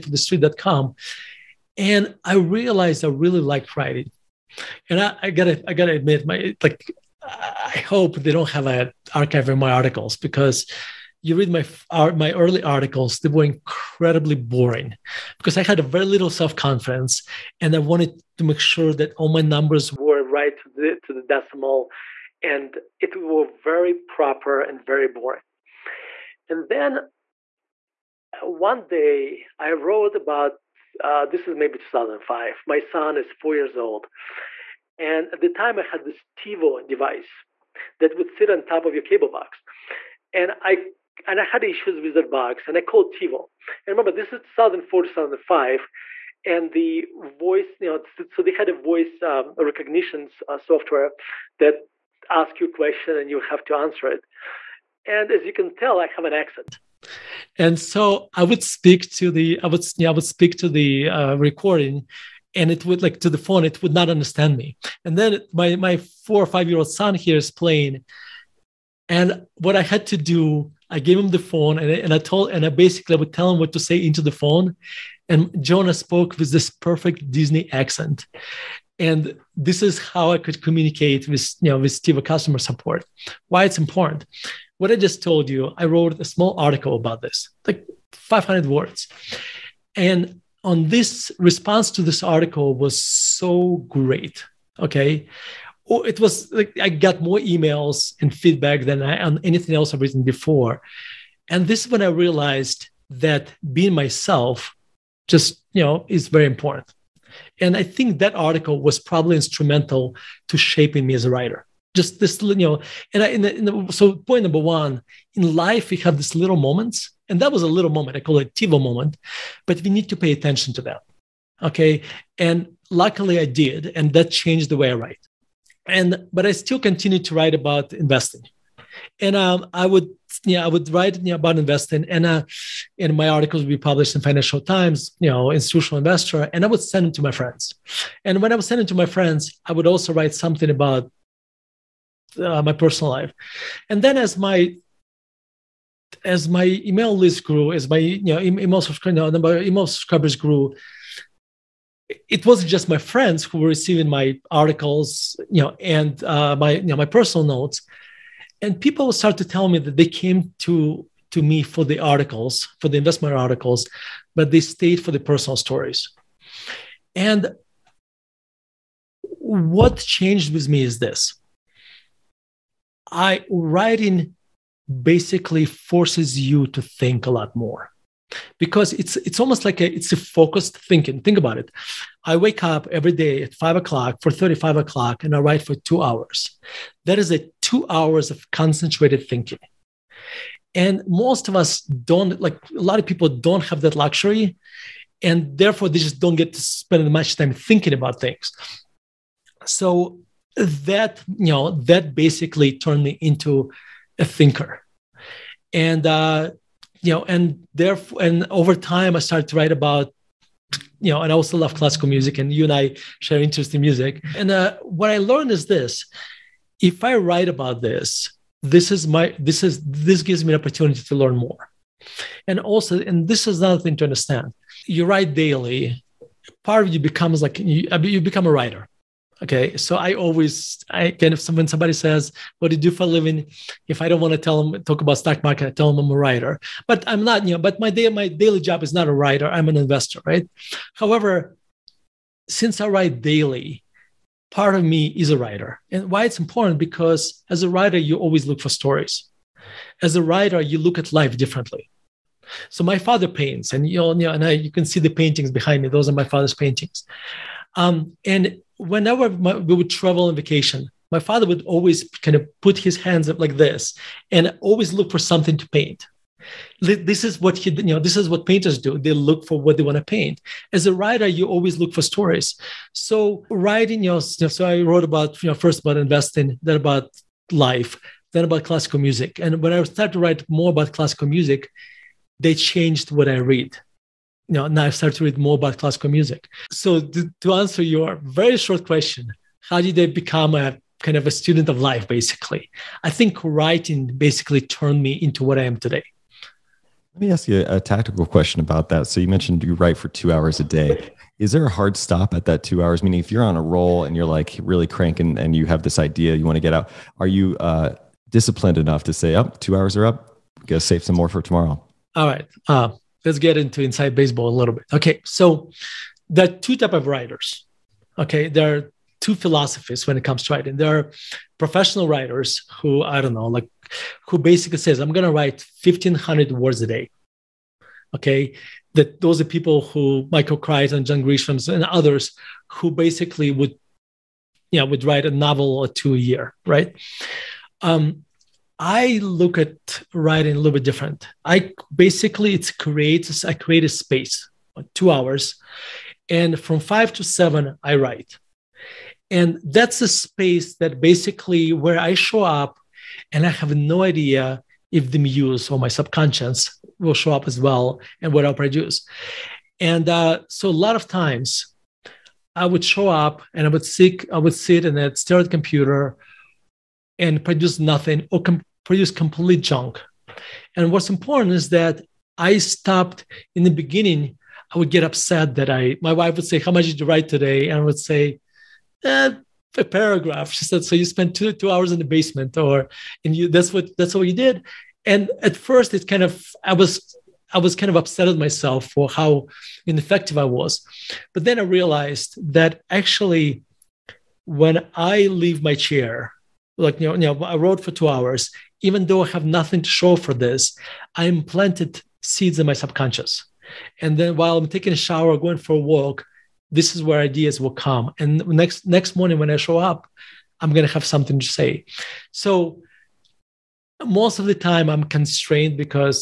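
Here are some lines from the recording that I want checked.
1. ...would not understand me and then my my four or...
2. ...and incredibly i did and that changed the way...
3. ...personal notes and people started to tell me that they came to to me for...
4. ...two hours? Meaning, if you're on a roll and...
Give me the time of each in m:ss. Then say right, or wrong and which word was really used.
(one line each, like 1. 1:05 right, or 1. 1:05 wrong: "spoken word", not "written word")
1. 1:03 right
2. 2:02 wrong: "luckily", not "incredibly"
3. 2:37 right
4. 5:02 right.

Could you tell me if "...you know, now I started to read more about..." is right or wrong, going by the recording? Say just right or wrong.
right.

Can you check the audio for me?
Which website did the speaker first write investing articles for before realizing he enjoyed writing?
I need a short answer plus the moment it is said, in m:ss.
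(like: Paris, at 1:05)
The Street.com, at 0:00.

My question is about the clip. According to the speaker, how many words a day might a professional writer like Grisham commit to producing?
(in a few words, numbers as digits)
1,500.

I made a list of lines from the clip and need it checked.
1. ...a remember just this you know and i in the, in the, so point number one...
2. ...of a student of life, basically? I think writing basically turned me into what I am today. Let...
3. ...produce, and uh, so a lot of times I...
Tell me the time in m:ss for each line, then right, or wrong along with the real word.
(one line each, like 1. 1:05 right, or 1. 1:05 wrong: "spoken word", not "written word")
1. 1:51 wrong: "writer", not "remember"
2. 4:51 right
3. 5:58 right.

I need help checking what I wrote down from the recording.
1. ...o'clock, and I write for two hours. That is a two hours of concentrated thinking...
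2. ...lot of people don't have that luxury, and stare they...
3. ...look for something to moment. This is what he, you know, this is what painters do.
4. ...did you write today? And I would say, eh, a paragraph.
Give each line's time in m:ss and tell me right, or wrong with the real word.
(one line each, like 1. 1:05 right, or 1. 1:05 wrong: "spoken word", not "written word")
1. 3:04 right
2. 3:12 wrong: "therefore", not "stare"
3. 4:24 wrong: "paint", not "moment"
4. 6:16 right.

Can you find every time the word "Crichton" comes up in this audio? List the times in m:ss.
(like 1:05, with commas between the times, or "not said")
5:30.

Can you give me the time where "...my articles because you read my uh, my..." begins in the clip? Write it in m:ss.
0:09.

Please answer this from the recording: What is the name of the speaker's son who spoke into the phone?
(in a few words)
Jonah.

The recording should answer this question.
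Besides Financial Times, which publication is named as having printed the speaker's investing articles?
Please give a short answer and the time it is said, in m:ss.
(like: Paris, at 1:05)
Institutional Investor, at 2:15.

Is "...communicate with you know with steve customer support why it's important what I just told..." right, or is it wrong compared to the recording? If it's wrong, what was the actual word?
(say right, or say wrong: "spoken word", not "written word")
right.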